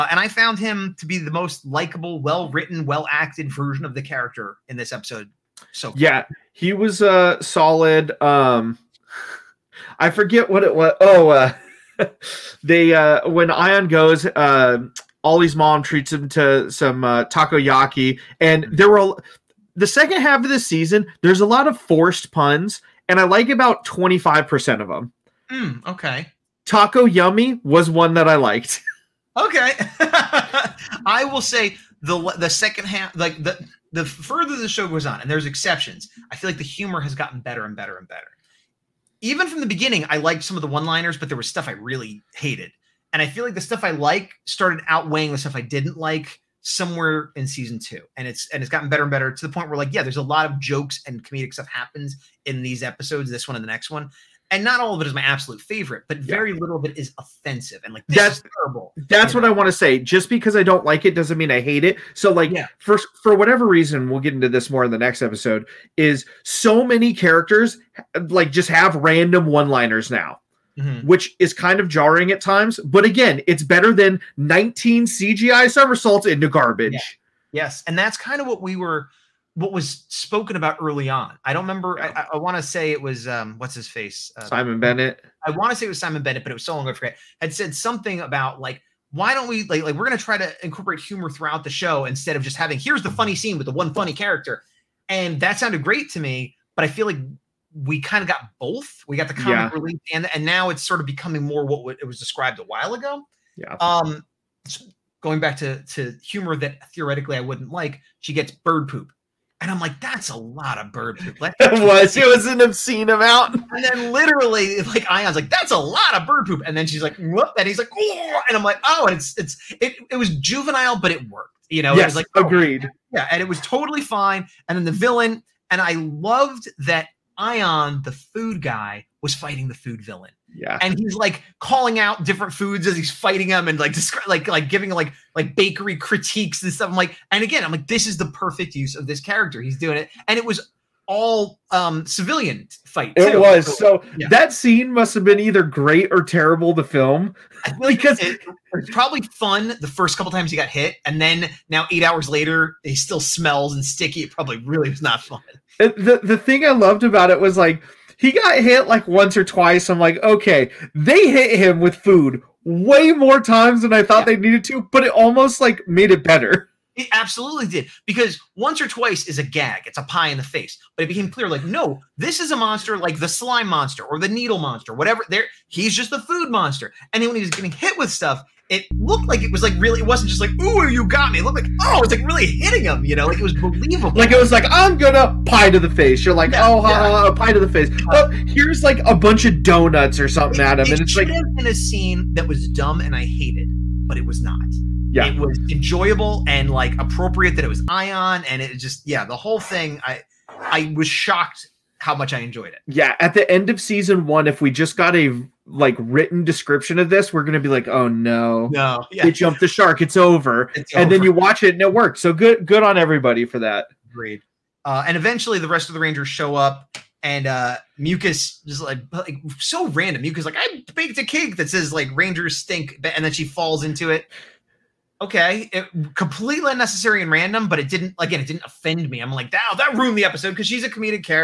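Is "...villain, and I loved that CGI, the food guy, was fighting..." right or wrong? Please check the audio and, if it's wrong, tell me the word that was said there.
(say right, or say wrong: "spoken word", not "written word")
wrong: "Aiyon", not "CGI".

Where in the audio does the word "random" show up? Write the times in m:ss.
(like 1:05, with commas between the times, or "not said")
1:08, 3:39, 3:47.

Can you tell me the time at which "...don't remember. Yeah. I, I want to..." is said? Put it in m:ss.
1:21.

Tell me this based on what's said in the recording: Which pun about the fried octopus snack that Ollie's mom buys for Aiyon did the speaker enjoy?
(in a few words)
Taco Yummy.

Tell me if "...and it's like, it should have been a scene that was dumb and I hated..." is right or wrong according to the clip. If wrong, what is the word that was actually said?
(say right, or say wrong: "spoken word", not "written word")
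right.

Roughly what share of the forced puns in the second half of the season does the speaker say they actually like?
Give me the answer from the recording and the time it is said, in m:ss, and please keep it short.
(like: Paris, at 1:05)
25%, at 0:23.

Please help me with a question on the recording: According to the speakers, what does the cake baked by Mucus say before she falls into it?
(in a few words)
Rangers stink.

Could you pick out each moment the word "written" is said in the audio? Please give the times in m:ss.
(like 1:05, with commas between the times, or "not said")
0:02, 3:25.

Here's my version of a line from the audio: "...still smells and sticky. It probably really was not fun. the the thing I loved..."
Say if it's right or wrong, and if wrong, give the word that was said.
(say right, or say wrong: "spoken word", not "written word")
right.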